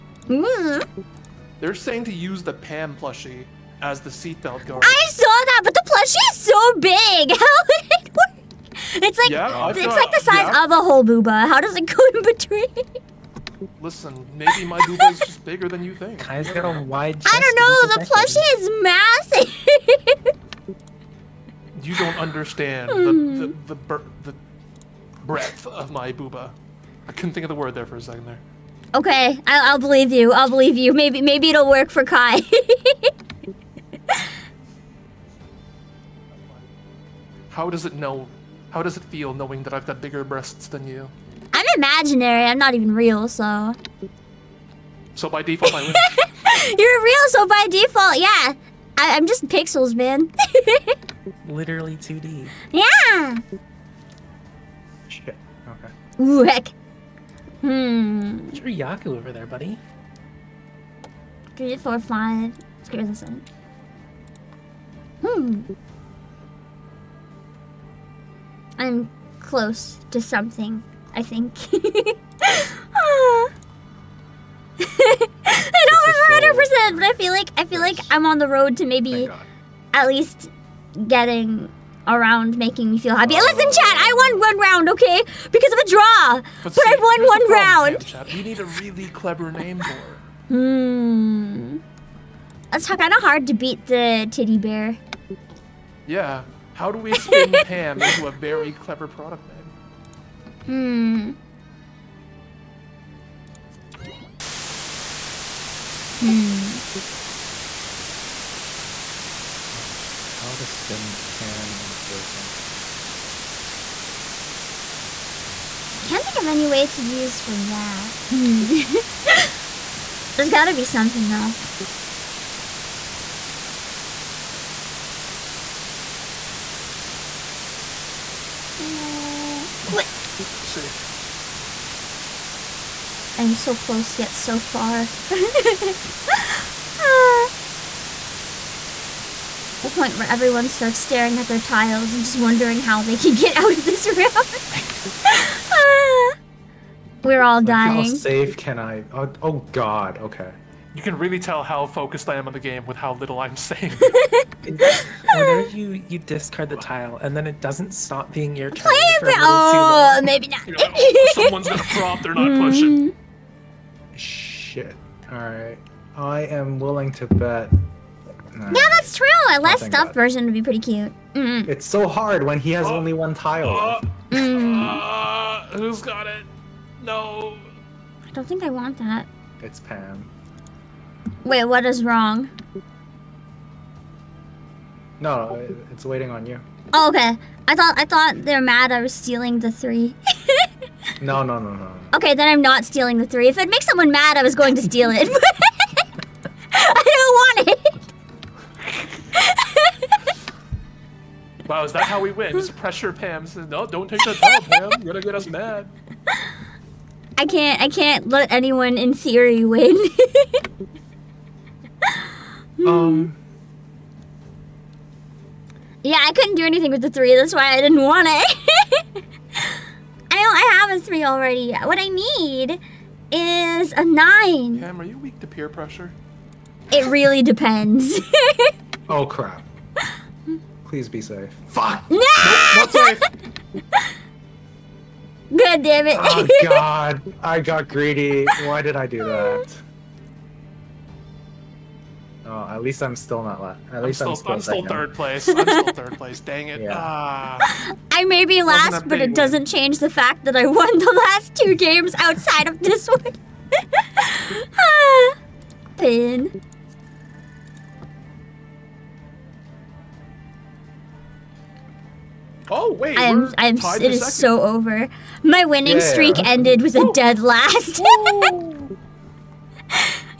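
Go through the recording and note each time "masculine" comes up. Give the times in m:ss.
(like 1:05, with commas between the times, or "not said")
not said.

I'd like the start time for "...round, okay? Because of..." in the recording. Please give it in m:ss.
1:24.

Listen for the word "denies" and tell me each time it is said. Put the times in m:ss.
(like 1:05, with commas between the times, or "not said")
not said.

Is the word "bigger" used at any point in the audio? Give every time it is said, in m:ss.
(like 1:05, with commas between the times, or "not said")
0:15, 0:40.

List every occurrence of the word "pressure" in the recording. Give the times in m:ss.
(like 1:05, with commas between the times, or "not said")
3:22, 3:45.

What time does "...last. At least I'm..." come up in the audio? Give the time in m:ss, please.
4:03.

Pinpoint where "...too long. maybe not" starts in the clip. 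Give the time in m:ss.
2:39.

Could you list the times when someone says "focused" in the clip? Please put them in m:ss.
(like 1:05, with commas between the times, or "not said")
2:31.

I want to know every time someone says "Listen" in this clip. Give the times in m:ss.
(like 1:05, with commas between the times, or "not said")
0:13, 1:23.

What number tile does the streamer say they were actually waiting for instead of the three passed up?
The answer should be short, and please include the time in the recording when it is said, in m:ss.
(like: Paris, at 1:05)
9, at 3:44.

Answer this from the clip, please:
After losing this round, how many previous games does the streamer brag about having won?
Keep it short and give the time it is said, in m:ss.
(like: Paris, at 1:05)
2, at 4:11.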